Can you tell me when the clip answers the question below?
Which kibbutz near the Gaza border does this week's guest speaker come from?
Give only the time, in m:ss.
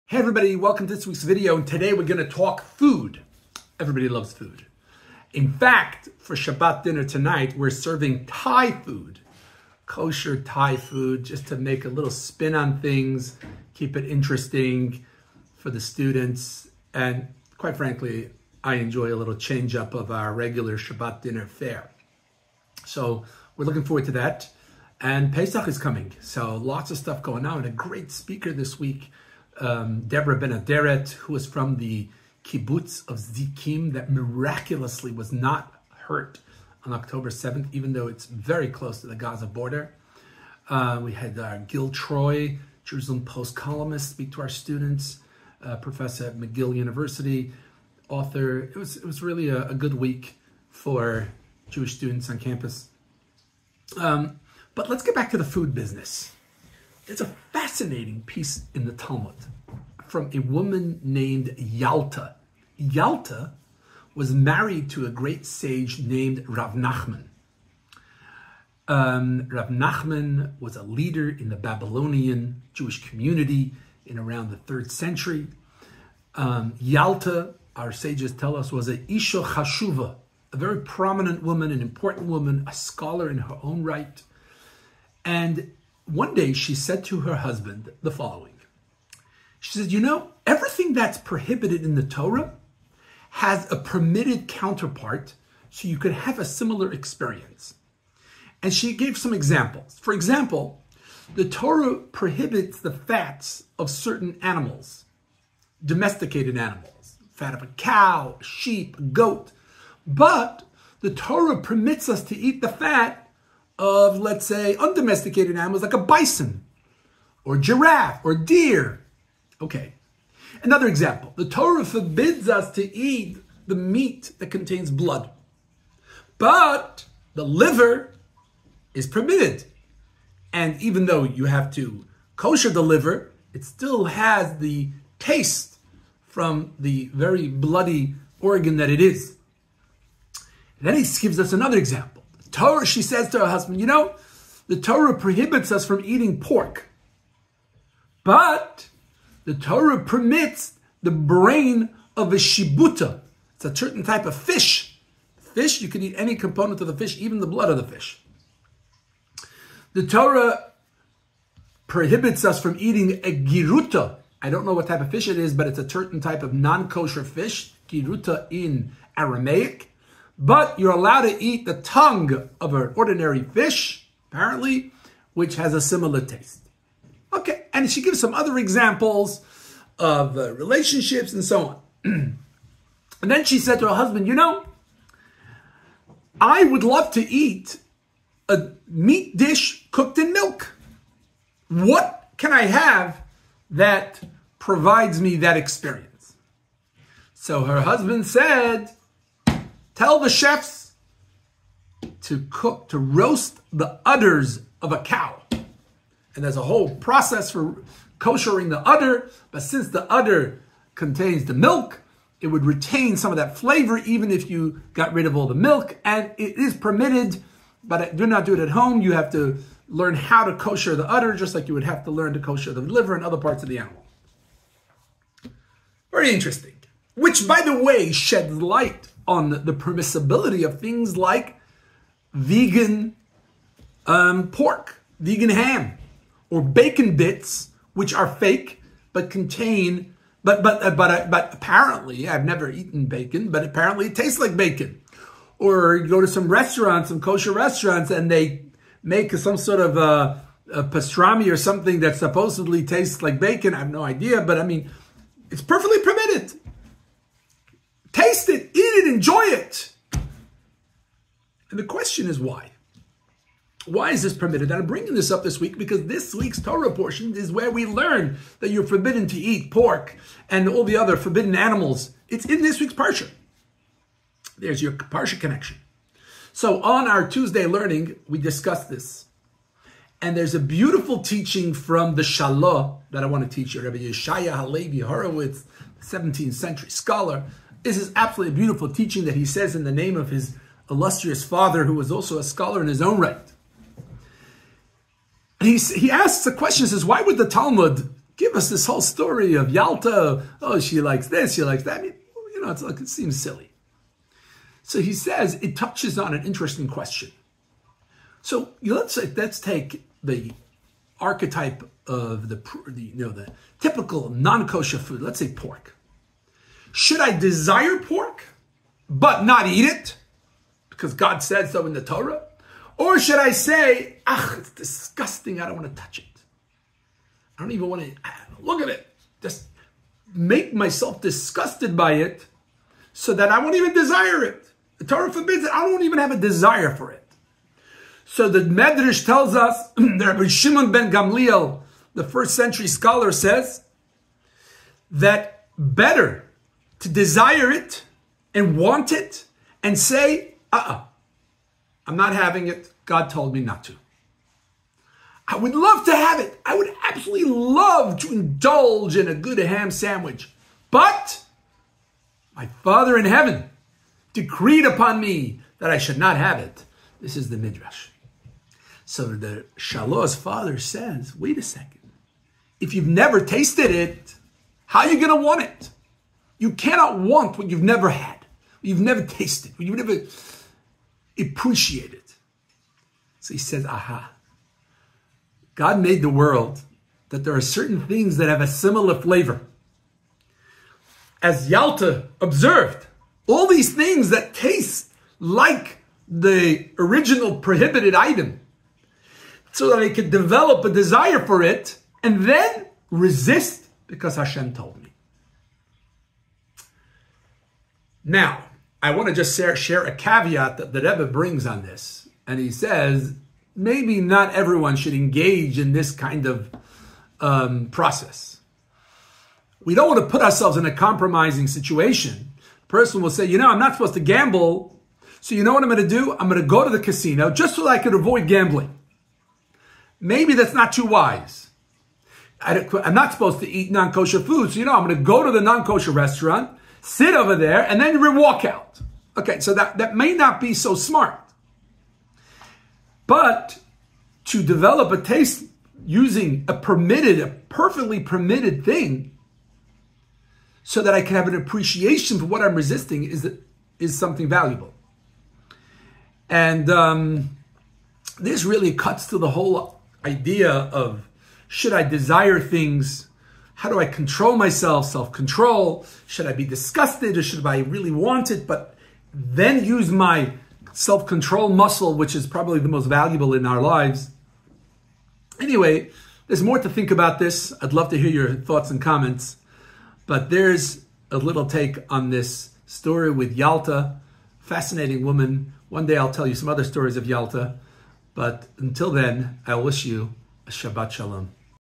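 0:33.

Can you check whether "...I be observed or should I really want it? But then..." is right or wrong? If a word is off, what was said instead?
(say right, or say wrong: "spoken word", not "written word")
wrong: "disgusted", not "observed".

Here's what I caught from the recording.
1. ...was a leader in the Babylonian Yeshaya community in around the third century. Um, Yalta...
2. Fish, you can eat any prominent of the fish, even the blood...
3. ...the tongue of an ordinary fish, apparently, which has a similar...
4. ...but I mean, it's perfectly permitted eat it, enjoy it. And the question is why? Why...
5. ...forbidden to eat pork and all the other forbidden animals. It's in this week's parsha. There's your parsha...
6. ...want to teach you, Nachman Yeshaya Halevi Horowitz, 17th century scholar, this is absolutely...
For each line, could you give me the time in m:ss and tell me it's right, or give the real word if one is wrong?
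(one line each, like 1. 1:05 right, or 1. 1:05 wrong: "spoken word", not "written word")
1. 1:10 wrong: "Jewish", not "Yeshaya"
2. 2:35 wrong: "component", not "prominent"
3. 2:51 right
4. 4:14 right
5. 4:28 right
6. 4:43 wrong: "Rabbi", not "Nachman".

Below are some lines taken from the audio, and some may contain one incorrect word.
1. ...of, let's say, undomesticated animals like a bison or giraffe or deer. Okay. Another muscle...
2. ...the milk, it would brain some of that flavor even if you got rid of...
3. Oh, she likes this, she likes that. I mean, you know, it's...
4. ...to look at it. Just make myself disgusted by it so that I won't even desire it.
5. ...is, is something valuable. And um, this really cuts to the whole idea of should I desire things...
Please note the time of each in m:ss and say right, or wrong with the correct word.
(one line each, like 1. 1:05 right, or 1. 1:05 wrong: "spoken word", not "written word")
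1. 1:53 wrong: "example", not "muscle"
2. 3:31 wrong: "retain", not "brain"
3. 5:00 right
4. 5:28 right
5. 7:33 right.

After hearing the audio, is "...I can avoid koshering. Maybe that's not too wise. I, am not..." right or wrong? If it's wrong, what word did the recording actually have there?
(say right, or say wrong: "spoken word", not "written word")
wrong: "gambling", not "koshering".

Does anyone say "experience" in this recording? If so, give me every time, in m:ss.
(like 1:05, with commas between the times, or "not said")
1:36, 3:15.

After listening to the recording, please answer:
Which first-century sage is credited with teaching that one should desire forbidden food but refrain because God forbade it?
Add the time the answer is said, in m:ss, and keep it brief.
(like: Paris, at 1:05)
Rabbi Shimon ben Gamliel, at 5:40.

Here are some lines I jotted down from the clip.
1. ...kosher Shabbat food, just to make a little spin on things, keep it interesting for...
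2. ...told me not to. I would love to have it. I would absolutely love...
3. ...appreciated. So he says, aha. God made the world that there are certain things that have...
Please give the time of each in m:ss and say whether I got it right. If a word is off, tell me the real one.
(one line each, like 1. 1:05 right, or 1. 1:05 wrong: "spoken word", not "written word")
1. 0:09 wrong: "Thai", not "Shabbat"
2. 5:53 right
3. 6:21 right.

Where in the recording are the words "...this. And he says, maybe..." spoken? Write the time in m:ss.
6:51.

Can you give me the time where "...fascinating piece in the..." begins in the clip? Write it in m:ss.
0:57.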